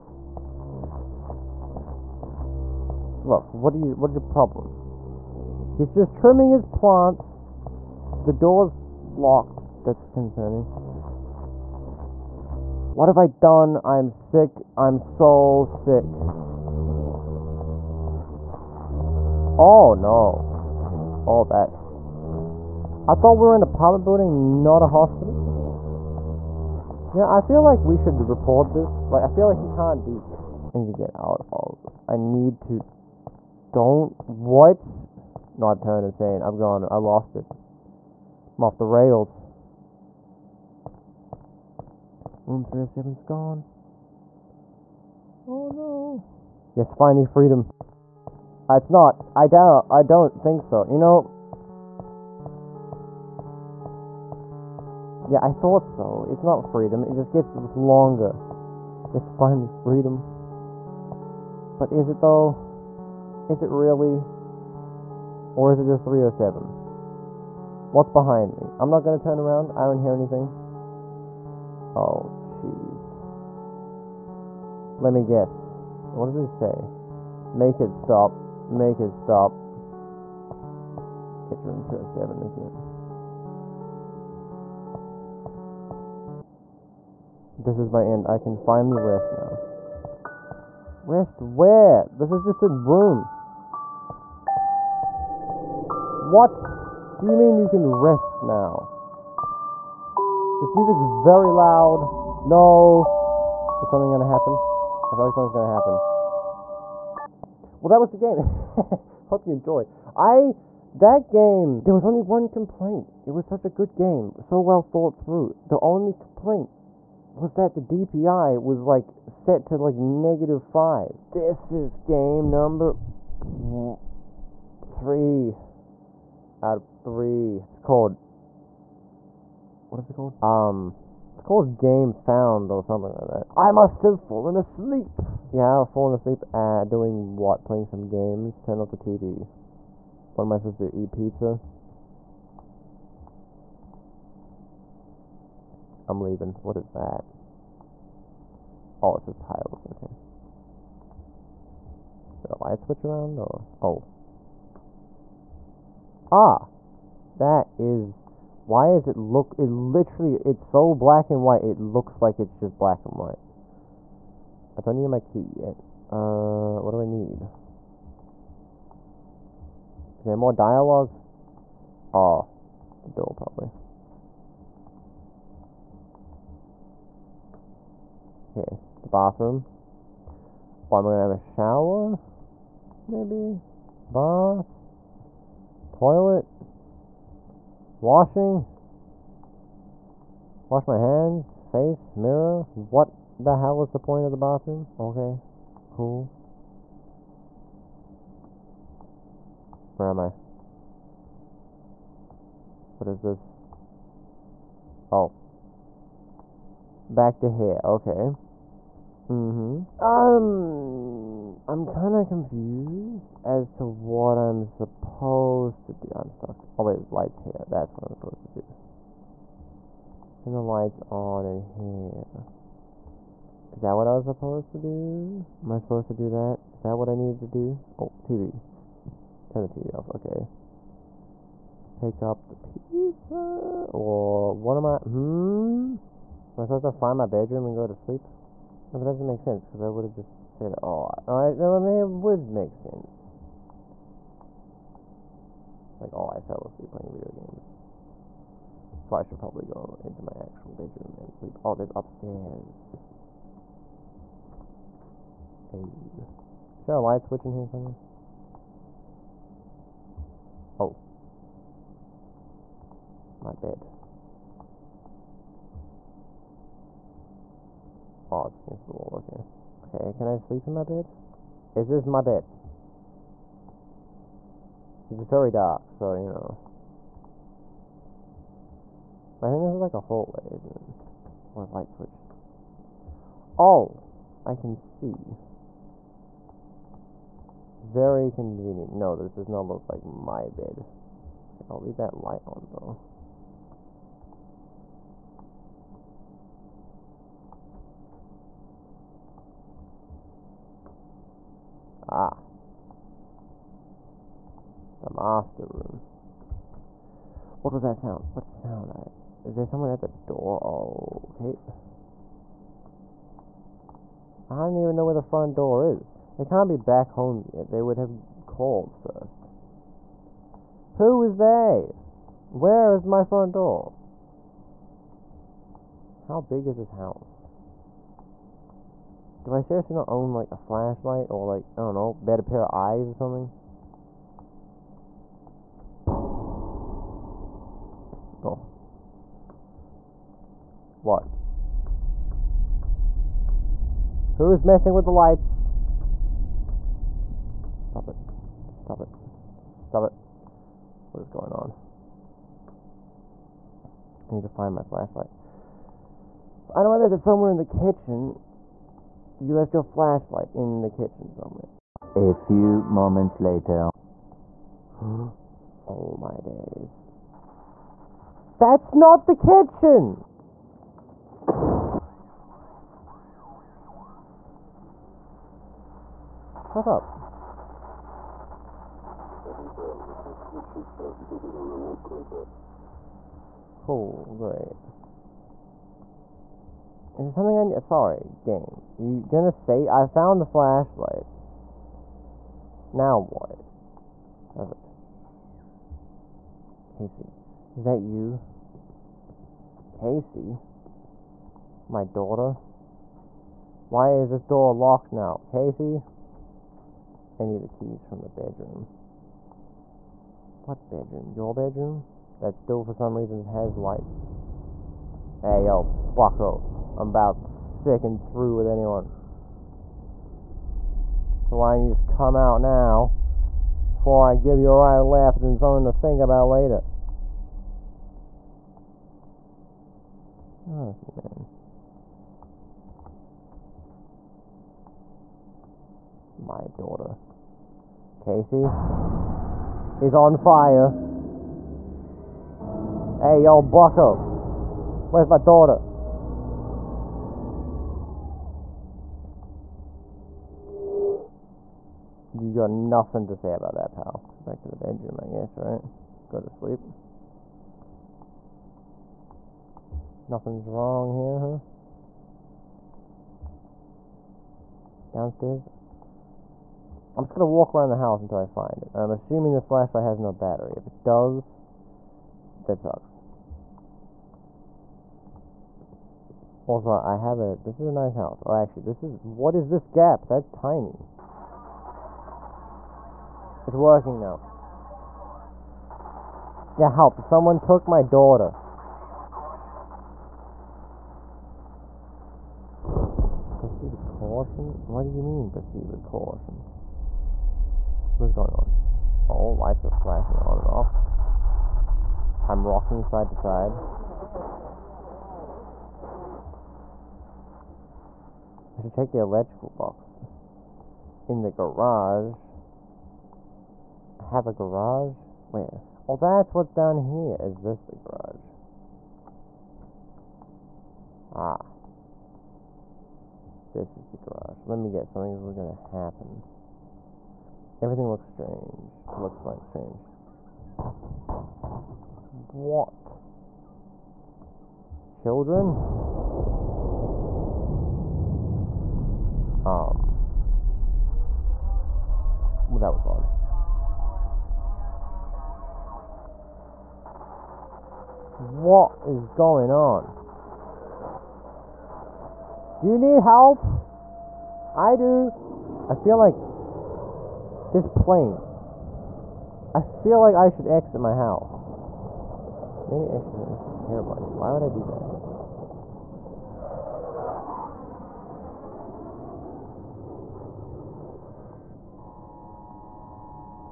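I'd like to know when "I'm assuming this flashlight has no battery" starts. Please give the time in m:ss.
7:48.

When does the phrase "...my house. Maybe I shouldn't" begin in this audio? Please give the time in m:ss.
9:21.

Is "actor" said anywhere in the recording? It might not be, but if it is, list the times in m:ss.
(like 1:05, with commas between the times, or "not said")
not said.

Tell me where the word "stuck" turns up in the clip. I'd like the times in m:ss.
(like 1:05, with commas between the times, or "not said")
3:36.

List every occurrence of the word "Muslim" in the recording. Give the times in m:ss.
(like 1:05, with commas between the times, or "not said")
not said.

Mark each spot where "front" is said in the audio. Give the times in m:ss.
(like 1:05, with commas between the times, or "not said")
5:15, 5:23.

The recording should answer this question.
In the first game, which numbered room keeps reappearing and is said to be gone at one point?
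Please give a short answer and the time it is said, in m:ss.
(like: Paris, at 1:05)
307, at 0:42.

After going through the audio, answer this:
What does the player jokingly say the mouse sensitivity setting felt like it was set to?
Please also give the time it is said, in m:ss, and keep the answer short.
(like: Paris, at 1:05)
negative 5, at 1:59.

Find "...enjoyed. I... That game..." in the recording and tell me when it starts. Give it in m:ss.
1:49.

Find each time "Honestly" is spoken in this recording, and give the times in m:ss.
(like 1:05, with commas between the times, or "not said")
7:10.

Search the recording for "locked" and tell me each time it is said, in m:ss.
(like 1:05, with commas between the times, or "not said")
0:09, 6:44.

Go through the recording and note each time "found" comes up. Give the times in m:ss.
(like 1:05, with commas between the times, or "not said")
2:12, 6:30.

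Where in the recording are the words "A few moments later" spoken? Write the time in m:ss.
6:02.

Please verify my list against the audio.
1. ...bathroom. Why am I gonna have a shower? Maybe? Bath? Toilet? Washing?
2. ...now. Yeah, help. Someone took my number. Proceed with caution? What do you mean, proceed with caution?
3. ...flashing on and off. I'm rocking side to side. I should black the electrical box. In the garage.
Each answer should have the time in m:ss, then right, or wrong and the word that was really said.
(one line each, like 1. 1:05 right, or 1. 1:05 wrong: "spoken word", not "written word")
1. 2:59 right
2. 8:04 wrong: "daughter", not "number"
3. 8:19 wrong: "check", not "black".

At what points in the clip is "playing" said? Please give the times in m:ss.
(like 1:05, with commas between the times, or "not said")
2:17, 4:06.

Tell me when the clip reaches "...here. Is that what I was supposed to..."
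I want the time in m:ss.
3:41.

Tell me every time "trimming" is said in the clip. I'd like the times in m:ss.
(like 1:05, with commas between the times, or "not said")
0:06.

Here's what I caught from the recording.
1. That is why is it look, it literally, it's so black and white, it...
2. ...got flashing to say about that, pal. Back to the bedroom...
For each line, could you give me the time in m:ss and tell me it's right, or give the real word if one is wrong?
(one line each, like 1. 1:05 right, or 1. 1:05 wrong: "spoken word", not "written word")
1. 2:37 right
2. 7:32 wrong: "nothing", not "flashing".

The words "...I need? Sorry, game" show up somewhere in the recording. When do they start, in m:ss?
6:27.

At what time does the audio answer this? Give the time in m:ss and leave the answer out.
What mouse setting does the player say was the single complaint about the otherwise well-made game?
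1:57.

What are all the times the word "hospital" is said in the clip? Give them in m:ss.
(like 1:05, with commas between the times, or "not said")
0:24.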